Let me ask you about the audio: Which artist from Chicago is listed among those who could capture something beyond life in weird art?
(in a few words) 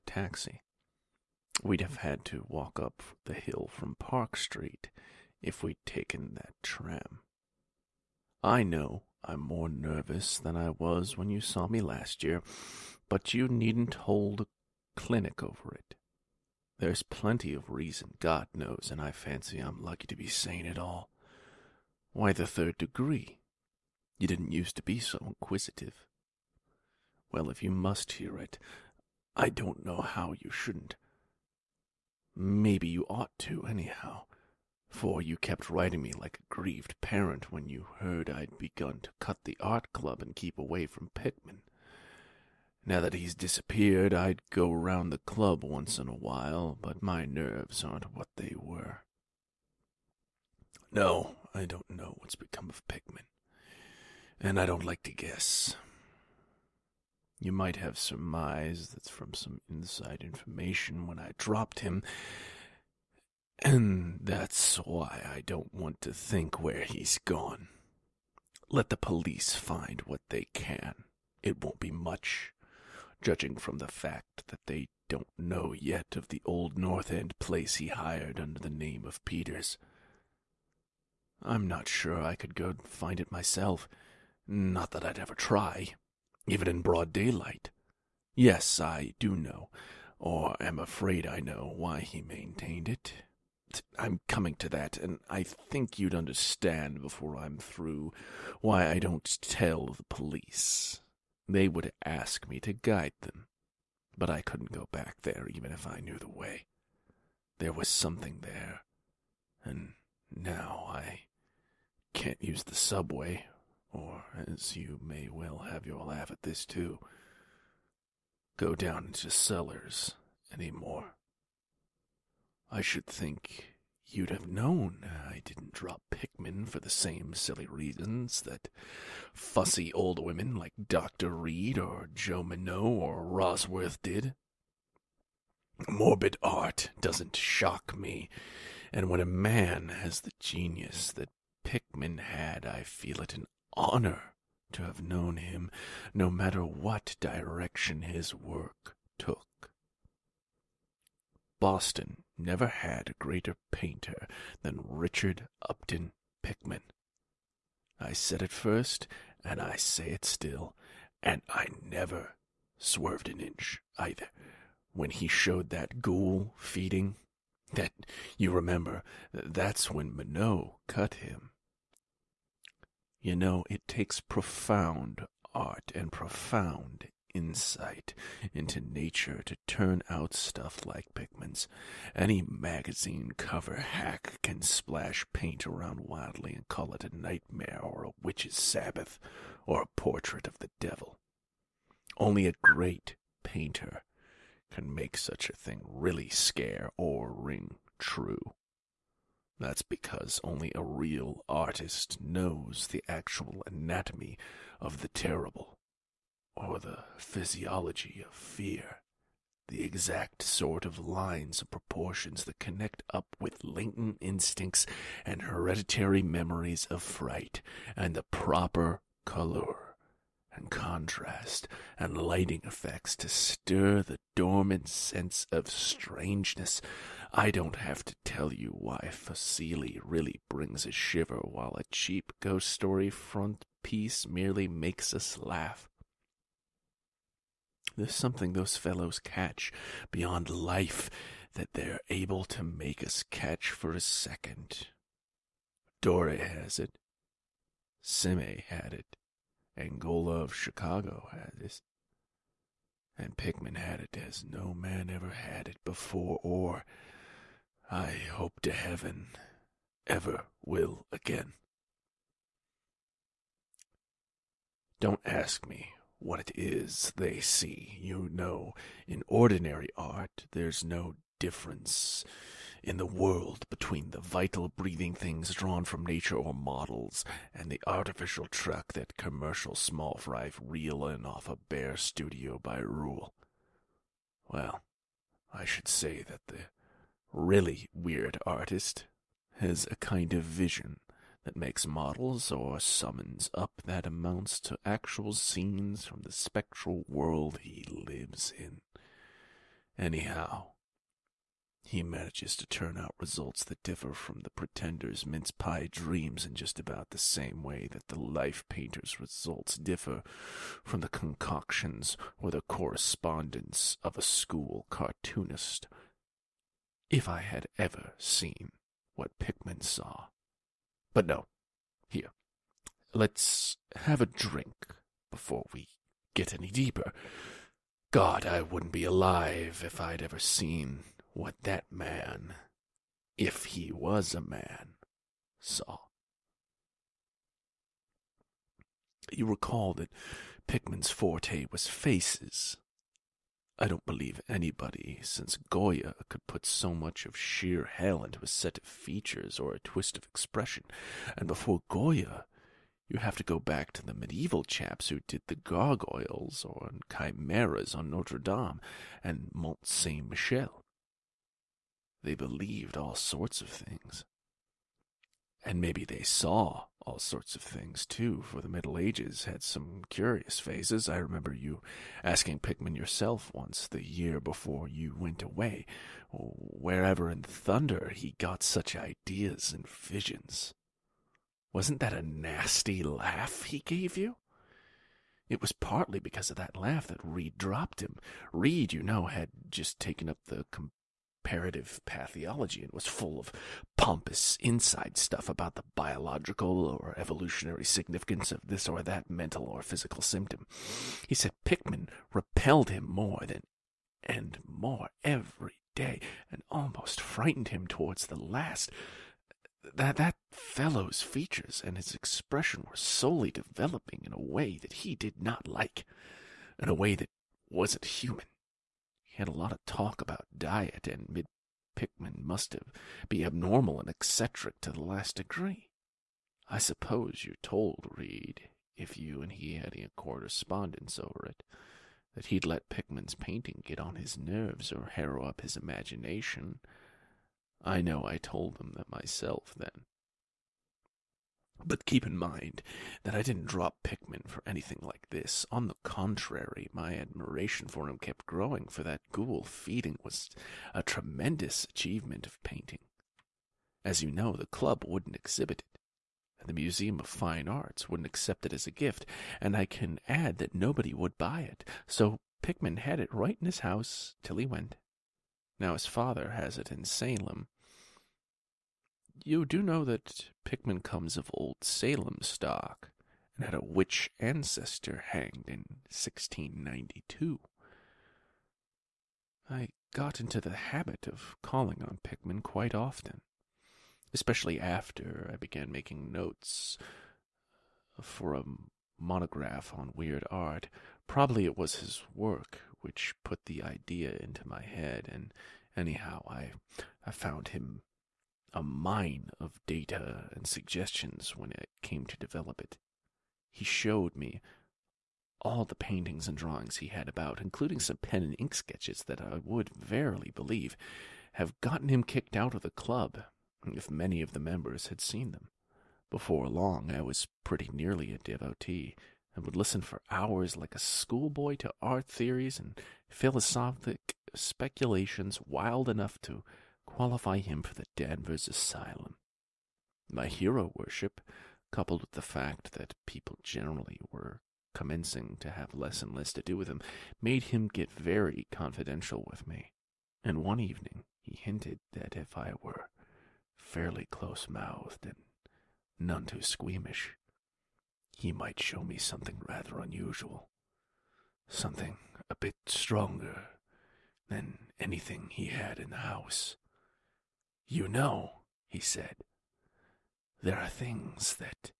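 Angarola.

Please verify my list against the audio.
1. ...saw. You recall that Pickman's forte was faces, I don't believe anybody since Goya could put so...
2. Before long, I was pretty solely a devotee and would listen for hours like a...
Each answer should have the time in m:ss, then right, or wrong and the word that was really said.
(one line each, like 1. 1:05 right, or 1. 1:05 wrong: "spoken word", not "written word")
1. 5:35 right
2. 8:36 wrong: "nearly", not "solely".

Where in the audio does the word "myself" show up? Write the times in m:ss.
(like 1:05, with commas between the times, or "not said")
1:23, 7:19.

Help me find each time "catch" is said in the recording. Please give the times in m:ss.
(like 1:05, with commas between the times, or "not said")
3:59, 4:03.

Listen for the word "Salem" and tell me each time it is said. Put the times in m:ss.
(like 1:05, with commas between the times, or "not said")
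7:47, 7:51.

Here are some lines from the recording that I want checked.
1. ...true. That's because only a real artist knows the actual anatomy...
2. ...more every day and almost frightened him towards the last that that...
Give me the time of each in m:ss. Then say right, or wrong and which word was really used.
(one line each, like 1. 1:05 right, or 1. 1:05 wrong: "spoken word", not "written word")
1. 3:17 right
2. 6:44 right.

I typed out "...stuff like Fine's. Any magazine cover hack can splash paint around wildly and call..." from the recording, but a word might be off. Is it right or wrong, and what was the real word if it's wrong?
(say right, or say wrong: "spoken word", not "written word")
wrong: "Pickman", not "Fine".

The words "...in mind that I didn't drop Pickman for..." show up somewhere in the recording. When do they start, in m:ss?
7:22.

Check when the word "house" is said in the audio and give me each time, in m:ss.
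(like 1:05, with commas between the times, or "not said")
7:43, 9:16.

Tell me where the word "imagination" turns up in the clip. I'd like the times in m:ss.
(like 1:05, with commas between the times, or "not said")
7:15.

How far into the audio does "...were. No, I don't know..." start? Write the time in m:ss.
0:48.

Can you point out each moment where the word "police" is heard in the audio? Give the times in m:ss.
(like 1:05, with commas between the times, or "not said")
1:08, 1:40.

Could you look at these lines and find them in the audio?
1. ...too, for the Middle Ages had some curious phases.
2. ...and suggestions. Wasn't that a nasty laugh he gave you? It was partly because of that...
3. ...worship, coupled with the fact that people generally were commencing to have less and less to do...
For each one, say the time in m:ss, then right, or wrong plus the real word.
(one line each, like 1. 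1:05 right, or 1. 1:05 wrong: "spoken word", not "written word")
1. 6:08 right
2. 6:19 wrong: "visions", not "suggestions"
3. 8:50 right.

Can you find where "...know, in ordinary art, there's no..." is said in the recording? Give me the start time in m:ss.
4:28.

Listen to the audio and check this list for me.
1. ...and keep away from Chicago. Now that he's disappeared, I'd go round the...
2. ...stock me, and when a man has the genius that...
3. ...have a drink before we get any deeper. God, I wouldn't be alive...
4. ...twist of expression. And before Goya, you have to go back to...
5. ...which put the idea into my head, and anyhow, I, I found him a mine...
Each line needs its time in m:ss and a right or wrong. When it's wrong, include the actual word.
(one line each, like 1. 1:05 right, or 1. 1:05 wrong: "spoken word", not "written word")
1. 0:40 wrong: "Pickman", not "Chicago"
2. 2:17 wrong: "shock", not "stock"
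3. 5:23 right
4. 5:49 right
5. 8:12 right.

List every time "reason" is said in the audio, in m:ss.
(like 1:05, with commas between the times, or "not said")
0:17, 2:07.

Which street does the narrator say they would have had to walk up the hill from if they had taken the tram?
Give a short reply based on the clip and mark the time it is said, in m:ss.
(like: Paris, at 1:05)
Park Street, at 0:03.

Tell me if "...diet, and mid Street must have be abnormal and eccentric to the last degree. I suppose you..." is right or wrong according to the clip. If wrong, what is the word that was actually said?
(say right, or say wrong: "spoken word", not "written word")
wrong: "Pickman", not "Street".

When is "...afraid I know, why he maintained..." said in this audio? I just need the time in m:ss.
1:30.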